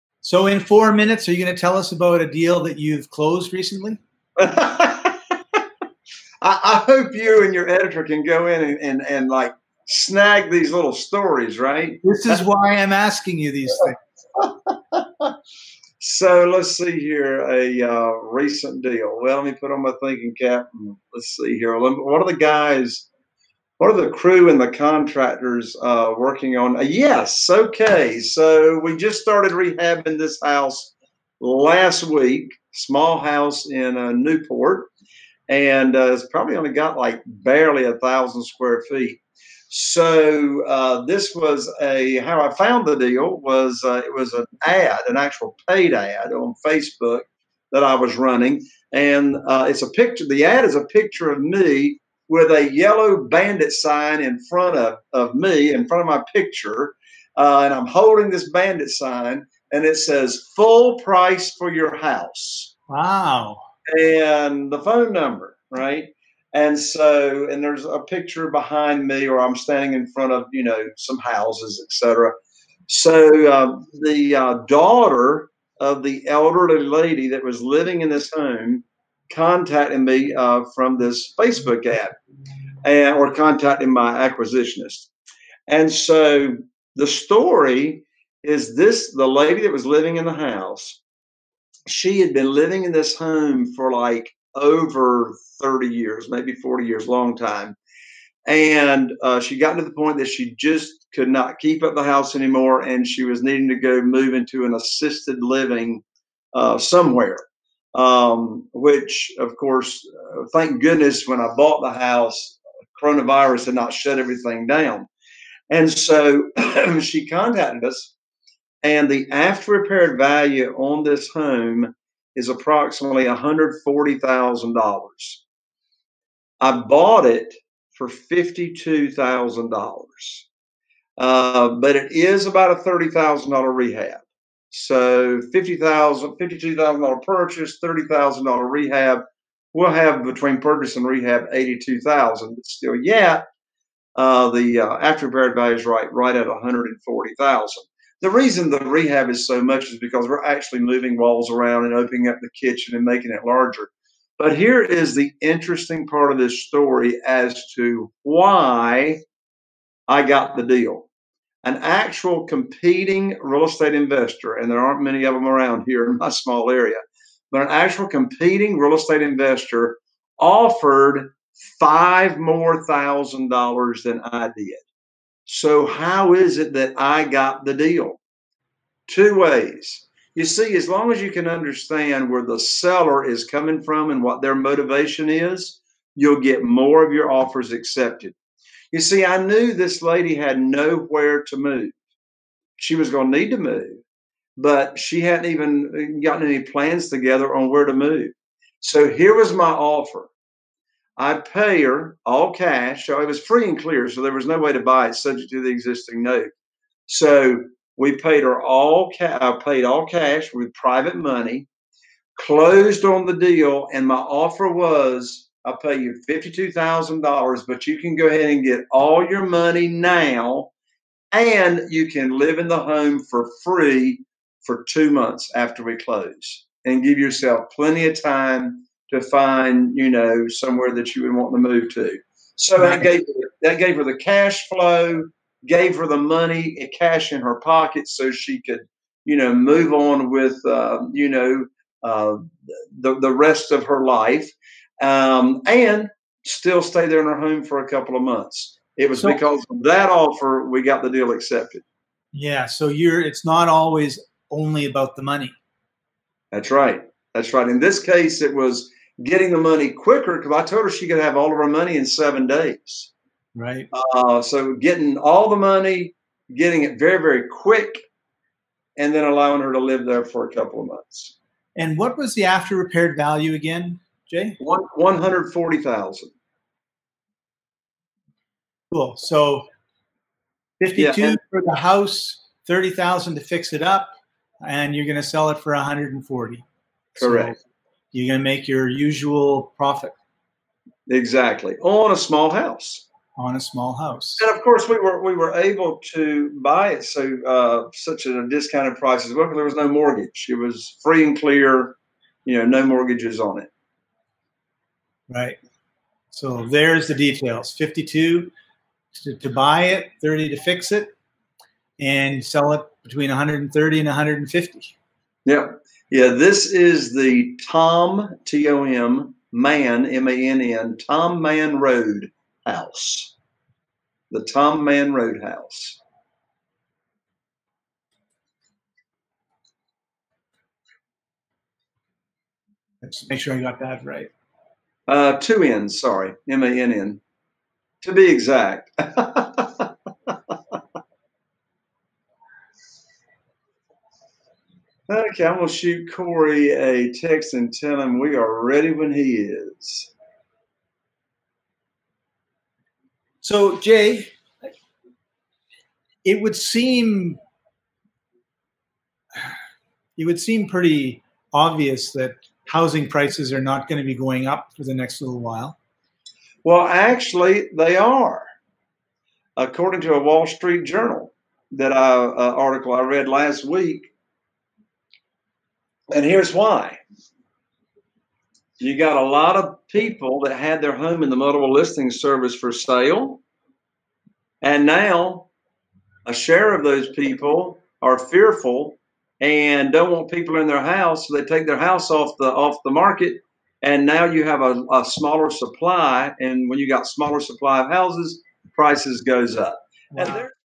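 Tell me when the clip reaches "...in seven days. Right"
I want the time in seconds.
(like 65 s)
261 s.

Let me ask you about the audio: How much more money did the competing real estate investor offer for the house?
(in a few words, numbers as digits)
$5,000.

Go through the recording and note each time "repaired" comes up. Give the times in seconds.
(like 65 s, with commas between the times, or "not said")
119 s, 145 s, 272 s.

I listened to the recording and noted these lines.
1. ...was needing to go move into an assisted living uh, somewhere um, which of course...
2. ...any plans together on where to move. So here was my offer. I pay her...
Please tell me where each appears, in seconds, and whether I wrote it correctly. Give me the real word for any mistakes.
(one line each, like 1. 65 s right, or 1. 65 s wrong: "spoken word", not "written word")
1. 103 s right
2. 196 s right.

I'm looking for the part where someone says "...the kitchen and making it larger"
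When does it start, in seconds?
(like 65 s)
152 s.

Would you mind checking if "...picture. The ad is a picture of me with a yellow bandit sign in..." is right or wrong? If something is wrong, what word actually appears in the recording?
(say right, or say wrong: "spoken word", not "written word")
right.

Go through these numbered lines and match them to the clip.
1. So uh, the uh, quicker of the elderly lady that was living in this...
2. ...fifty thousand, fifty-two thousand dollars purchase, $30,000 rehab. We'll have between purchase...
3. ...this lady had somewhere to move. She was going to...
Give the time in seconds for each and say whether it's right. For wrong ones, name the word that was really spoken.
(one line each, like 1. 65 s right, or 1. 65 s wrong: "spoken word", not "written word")
1. 72 s wrong: "daughter", not "quicker"
2. 135 s right
3. 189 s wrong: "nowhere", not "somewhere".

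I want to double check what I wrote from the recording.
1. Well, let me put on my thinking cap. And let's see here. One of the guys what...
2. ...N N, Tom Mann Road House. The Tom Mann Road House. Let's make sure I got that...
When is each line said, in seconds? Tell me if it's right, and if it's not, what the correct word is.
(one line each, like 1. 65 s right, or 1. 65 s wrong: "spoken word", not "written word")
1. 19 s right
2. 320 s right.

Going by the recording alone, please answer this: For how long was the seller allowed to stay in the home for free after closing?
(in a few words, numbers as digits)
2 months.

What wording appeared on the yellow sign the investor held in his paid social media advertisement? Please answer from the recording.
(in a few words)
Full price for your house.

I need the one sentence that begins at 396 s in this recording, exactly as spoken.
And when you got smaller supply of houses, prices goes up.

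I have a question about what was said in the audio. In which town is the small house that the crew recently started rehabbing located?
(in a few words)
Newport.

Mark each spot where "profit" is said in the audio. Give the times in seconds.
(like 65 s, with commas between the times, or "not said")
289 s.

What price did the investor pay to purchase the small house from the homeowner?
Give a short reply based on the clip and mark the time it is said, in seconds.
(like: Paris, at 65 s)
$52,000, at 126 s.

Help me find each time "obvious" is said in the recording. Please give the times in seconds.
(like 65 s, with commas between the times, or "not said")
361 s.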